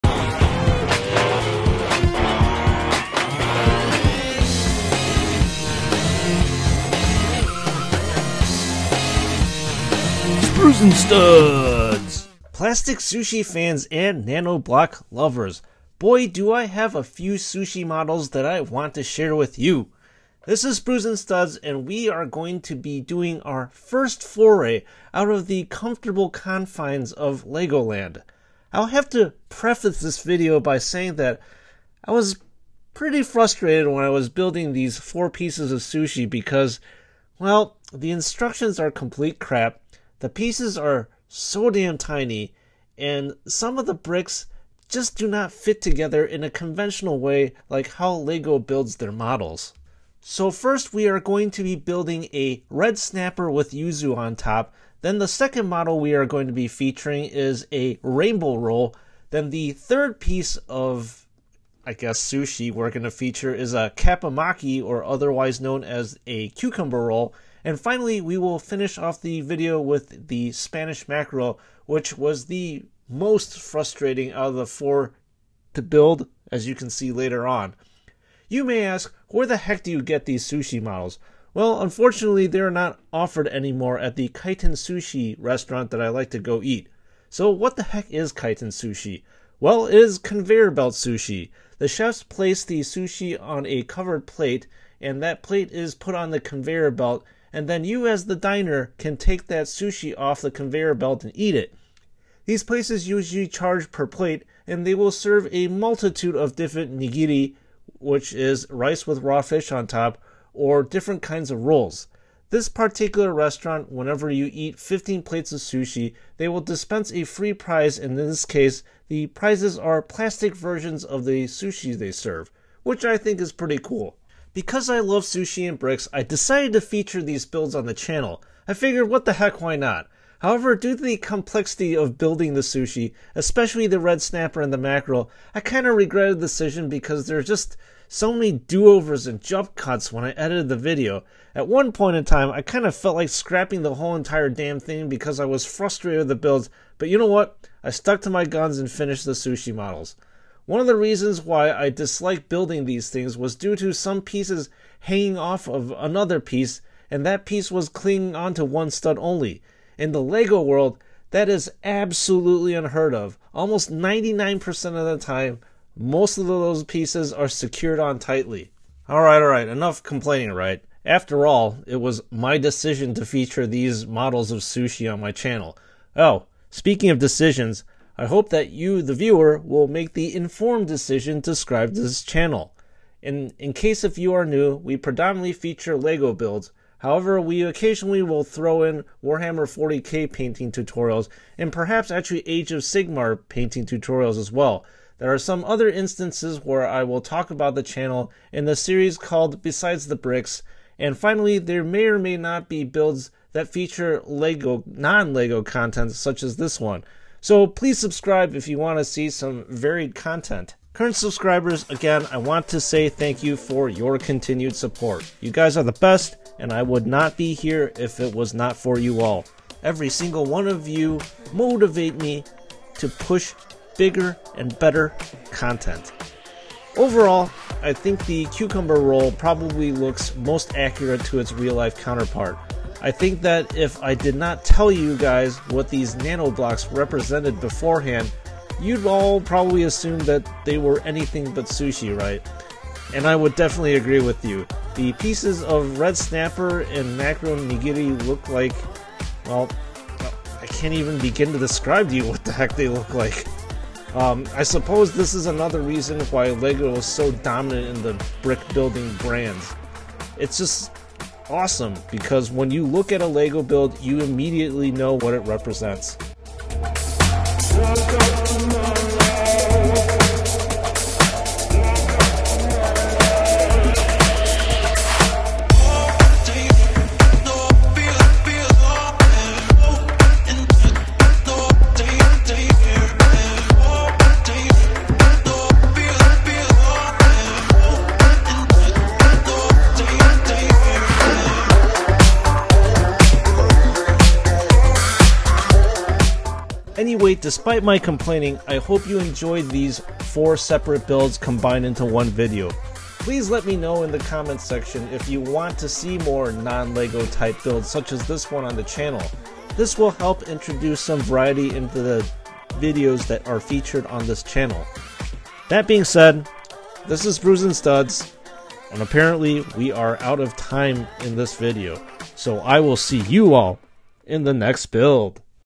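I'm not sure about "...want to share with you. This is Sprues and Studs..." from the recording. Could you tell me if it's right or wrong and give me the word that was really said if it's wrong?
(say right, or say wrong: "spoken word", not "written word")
right.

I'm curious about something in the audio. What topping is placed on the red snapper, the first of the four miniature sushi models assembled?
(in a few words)
yuzu.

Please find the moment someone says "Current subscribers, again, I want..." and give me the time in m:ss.
3:30.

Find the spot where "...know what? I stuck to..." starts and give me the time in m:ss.
2:27.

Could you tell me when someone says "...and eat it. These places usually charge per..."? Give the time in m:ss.
1:41.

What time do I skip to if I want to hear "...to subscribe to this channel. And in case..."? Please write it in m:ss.
3:01.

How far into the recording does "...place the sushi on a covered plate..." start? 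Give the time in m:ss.
1:32.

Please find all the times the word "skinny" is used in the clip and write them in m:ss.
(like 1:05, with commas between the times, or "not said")
not said.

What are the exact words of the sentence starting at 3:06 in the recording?
However, we occasionally will throw in Warhammer 40k painting tutorials and perhaps actually Age of Sigmar painting tutorials as well.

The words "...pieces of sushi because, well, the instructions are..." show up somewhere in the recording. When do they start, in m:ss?
0:35.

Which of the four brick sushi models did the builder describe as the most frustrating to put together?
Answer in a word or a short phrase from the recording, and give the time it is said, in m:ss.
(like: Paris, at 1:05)
Spanish mackerel, at 1:10.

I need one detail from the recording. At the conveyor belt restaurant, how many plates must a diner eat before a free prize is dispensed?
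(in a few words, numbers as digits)
15.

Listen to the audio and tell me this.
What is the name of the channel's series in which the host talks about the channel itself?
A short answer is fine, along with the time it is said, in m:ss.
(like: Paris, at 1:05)
Besides the Bricks, at 3:19.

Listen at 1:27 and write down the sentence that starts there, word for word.
So, what the heck is Kaiten Sushi?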